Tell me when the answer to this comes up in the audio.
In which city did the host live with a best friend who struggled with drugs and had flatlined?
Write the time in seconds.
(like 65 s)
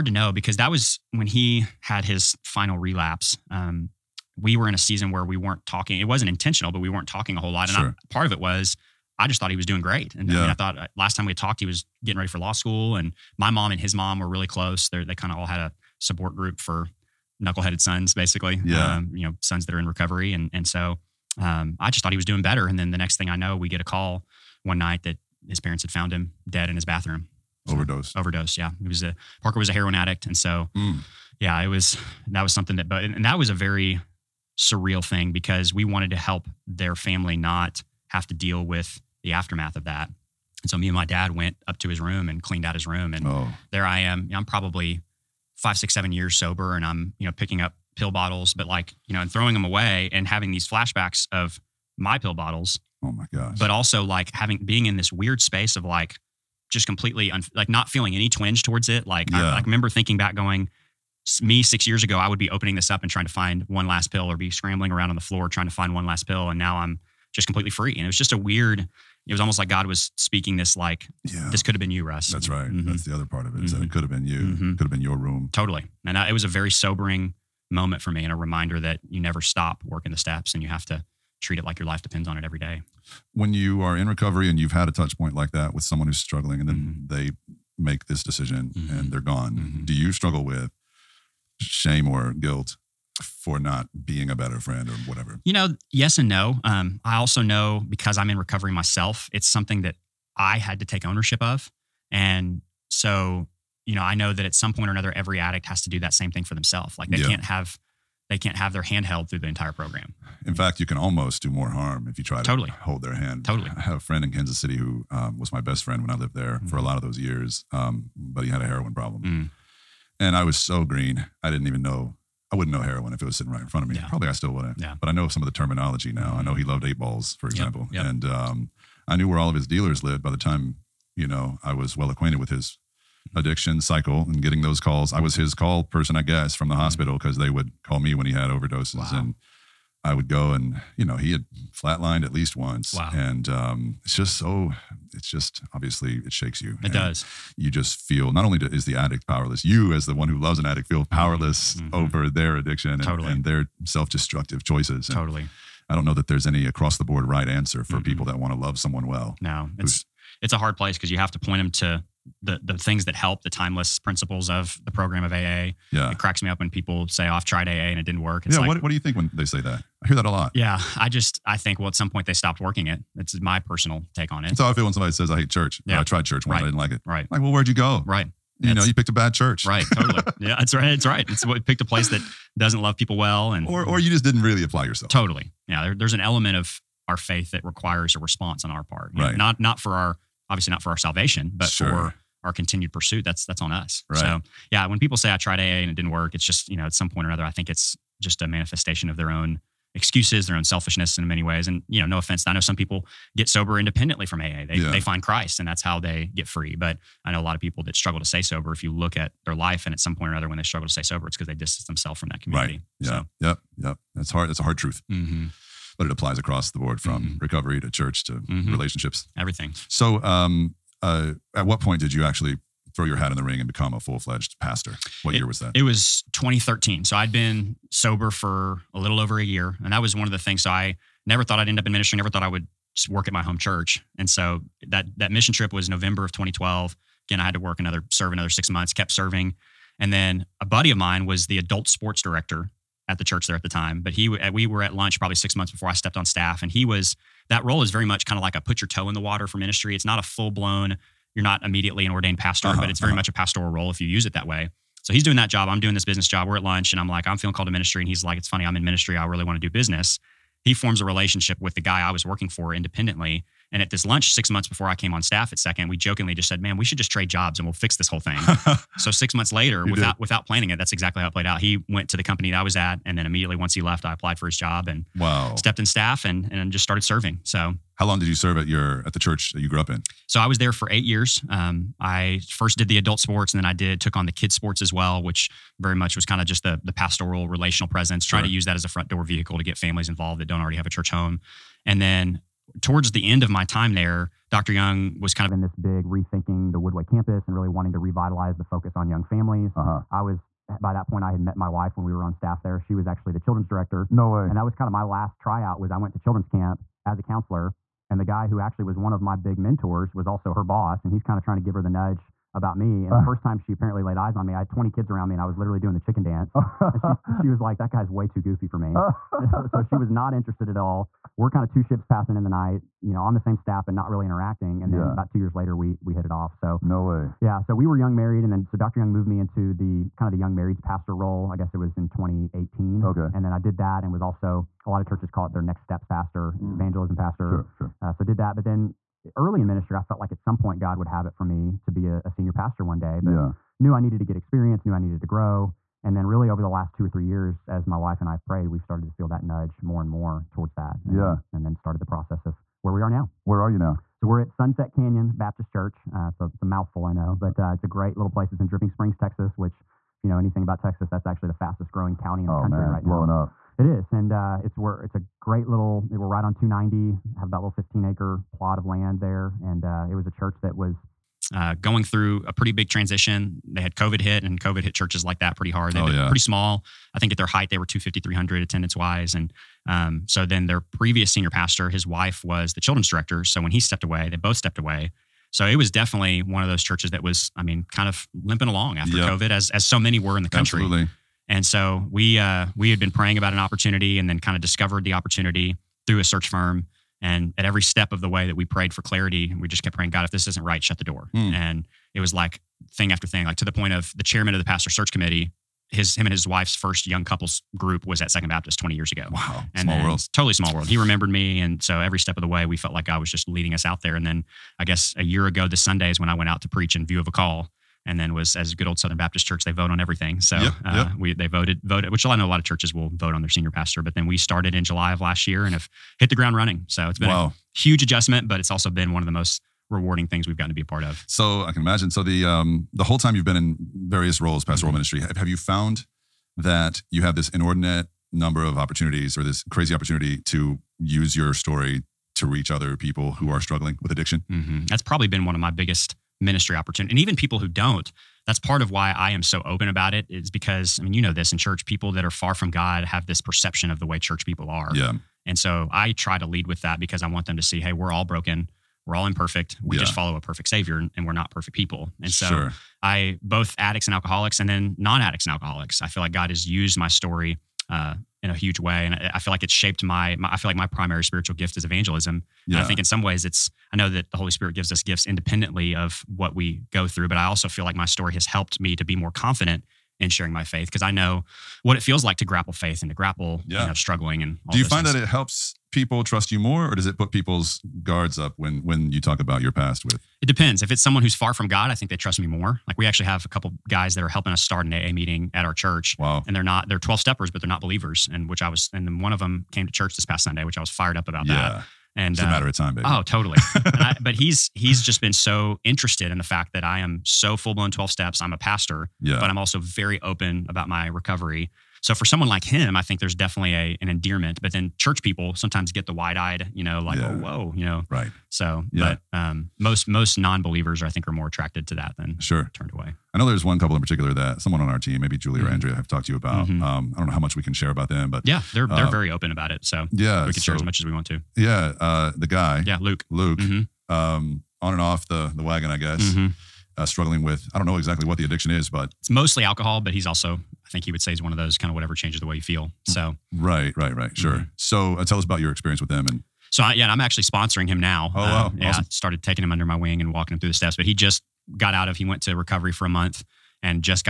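113 s.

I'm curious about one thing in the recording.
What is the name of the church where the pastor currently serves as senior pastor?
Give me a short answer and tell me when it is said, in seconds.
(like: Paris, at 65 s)
Sunset Canyon Baptist Church, at 354 s.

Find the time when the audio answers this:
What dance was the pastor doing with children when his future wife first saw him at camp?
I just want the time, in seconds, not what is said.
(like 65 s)
315 s.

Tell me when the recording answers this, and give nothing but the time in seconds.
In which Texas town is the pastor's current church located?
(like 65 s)
358 s.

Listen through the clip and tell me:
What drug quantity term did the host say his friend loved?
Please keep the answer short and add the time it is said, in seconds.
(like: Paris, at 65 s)
Eight balls, at 126 s.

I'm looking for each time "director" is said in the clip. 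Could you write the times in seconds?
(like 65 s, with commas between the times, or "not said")
242 s, 303 s, 383 s.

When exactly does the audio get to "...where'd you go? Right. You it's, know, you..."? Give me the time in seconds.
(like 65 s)
177 s.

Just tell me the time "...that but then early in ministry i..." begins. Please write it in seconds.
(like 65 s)
338 s.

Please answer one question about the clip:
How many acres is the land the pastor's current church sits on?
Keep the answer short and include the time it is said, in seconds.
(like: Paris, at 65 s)
15, at 367 s.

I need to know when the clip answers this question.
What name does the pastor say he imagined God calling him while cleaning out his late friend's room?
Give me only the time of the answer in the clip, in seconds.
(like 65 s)
71 s.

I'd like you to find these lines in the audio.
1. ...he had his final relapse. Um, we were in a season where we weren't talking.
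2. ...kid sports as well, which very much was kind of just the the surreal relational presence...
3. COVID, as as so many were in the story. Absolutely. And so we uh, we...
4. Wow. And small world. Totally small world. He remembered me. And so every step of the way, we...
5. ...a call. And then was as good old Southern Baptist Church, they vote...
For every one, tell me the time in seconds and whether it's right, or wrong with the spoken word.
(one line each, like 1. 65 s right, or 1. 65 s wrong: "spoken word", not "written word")
1. 1 s right
2. 284 s wrong: "pastoral", not "surreal"
3. 389 s wrong: "country", not "story"
4. 409 s right
5. 417 s right.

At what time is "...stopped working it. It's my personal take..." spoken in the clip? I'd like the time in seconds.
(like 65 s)
172 s.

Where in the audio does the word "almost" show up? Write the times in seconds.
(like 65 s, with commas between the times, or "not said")
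69 s, 110 s.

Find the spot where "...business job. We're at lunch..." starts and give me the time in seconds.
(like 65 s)
256 s.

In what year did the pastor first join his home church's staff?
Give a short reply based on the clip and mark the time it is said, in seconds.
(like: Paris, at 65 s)
2013, at 225 s.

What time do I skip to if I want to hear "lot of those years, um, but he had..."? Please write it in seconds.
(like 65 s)
116 s.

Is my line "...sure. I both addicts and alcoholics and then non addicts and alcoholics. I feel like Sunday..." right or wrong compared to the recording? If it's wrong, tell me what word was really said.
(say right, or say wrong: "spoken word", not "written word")
wrong: "God", not "Sunday".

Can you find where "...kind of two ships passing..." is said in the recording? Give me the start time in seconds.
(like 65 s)
321 s.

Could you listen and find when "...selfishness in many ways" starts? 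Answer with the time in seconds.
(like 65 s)
200 s.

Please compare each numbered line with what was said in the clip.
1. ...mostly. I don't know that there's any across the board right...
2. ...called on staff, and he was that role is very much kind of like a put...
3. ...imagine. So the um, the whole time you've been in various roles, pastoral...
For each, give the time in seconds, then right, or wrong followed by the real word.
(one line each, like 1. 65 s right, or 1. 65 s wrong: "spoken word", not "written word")
1. 155 s wrong: "totally", not "mostly"
2. 245 s wrong: "stepped", not "called"
3. 431 s right.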